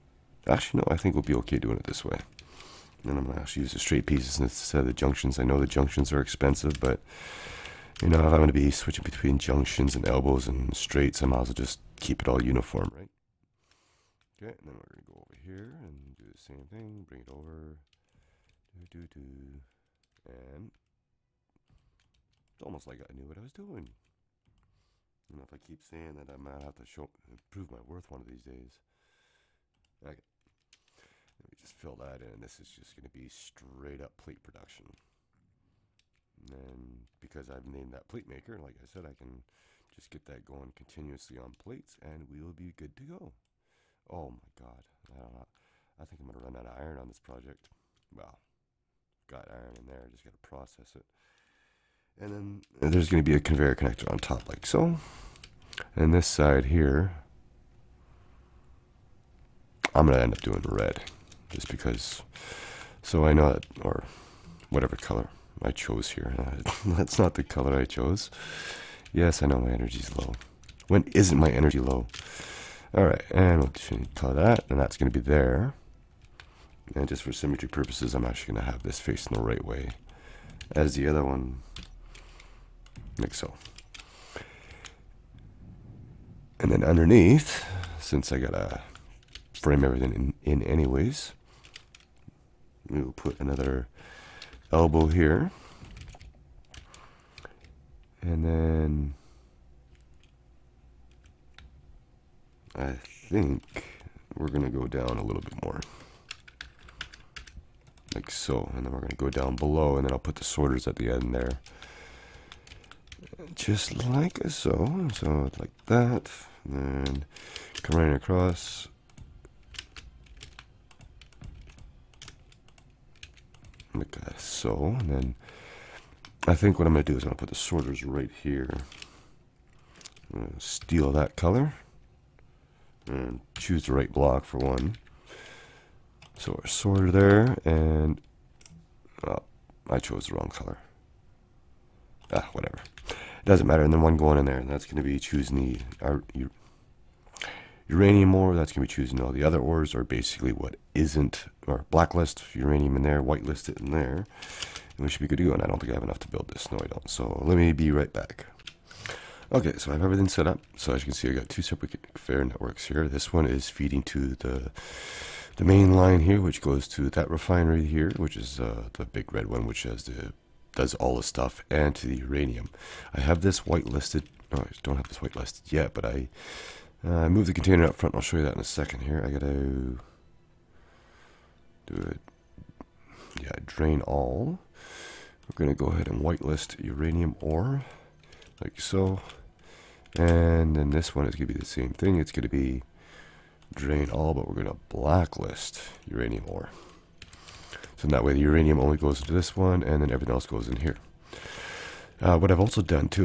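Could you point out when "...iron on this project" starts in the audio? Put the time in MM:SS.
00:46.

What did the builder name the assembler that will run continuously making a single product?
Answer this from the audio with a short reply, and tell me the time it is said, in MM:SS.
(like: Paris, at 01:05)
pleat maker, at 00:38.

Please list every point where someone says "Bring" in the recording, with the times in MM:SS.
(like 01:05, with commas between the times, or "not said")
00:17.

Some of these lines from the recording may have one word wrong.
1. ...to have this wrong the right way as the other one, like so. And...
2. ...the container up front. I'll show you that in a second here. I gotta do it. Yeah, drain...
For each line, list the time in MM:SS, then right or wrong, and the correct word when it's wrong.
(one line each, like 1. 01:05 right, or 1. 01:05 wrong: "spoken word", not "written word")
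1. 01:18 wrong: "facing", not "wrong"
2. 02:57 right.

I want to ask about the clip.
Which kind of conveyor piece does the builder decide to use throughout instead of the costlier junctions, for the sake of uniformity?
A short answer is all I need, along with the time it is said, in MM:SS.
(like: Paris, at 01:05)
straight pieces, at 00:03.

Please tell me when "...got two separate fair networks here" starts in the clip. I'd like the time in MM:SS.
02:41.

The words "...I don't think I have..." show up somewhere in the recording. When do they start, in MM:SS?
02:35.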